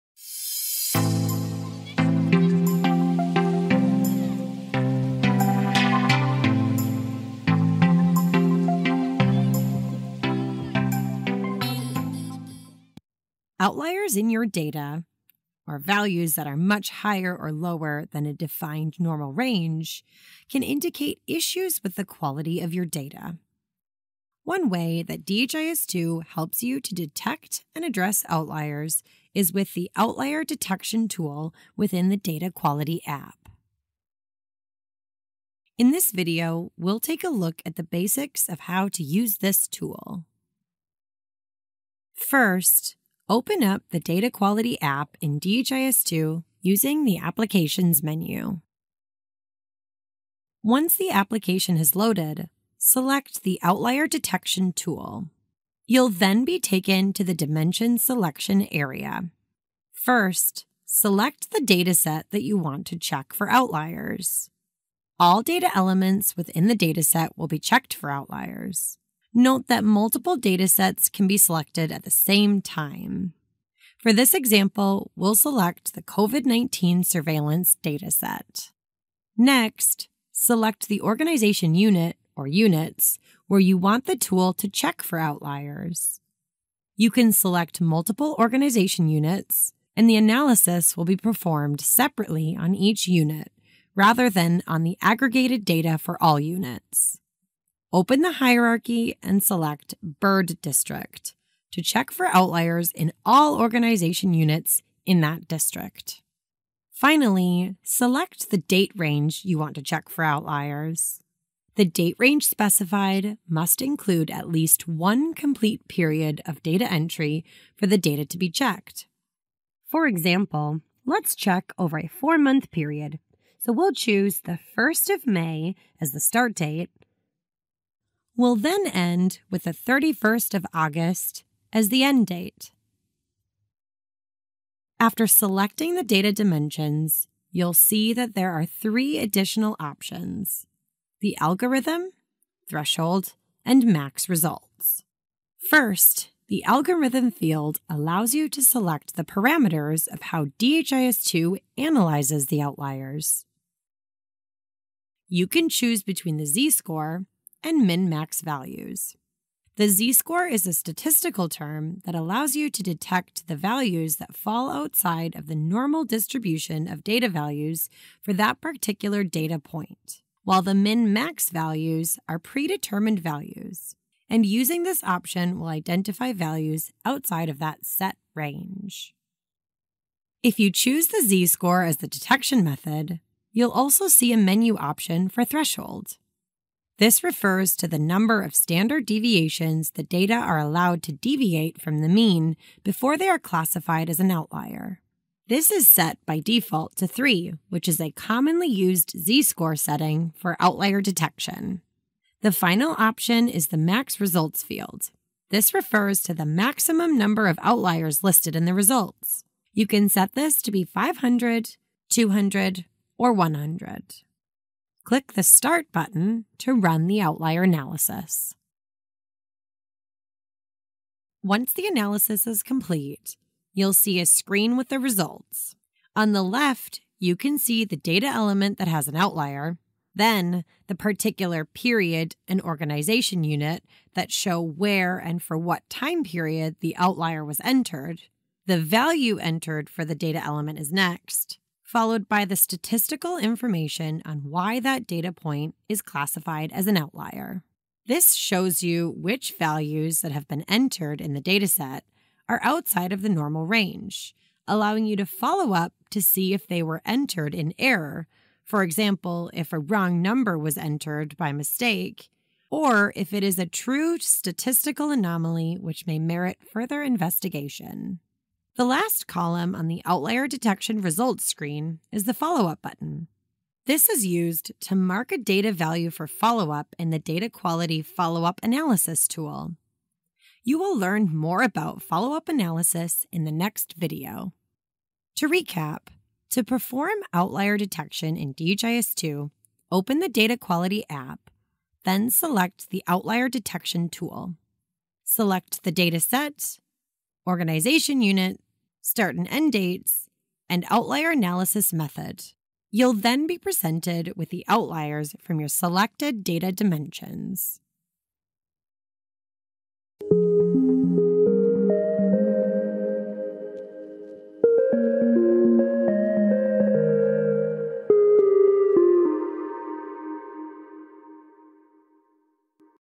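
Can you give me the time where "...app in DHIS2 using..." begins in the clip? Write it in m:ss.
0:44.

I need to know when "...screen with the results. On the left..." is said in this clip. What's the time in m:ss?
3:44.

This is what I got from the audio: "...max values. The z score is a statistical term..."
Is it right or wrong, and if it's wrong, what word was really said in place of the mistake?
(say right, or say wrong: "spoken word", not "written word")
right.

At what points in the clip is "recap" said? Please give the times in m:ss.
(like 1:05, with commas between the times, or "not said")
4:45.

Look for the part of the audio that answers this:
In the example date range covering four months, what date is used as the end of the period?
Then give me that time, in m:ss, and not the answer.
2:09.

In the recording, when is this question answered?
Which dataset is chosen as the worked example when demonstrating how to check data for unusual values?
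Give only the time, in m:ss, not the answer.
1:16.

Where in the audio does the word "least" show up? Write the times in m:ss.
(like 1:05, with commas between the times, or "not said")
1:54.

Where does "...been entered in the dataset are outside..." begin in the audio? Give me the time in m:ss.
4:10.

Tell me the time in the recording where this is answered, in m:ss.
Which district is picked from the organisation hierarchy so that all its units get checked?
1:40.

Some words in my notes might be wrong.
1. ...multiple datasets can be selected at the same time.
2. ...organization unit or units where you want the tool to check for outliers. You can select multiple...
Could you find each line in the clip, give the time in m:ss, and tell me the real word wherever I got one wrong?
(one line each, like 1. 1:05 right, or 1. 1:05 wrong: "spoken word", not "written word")
1. 1:09 right
2. 1:20 right.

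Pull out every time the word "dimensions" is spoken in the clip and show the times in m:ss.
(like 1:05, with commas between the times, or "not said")
0:57, 2:16, 5:06.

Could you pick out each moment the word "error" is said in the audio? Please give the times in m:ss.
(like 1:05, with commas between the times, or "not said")
4:17.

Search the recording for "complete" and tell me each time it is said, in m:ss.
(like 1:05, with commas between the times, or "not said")
1:55, 3:42.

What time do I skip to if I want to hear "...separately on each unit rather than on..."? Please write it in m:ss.
1:31.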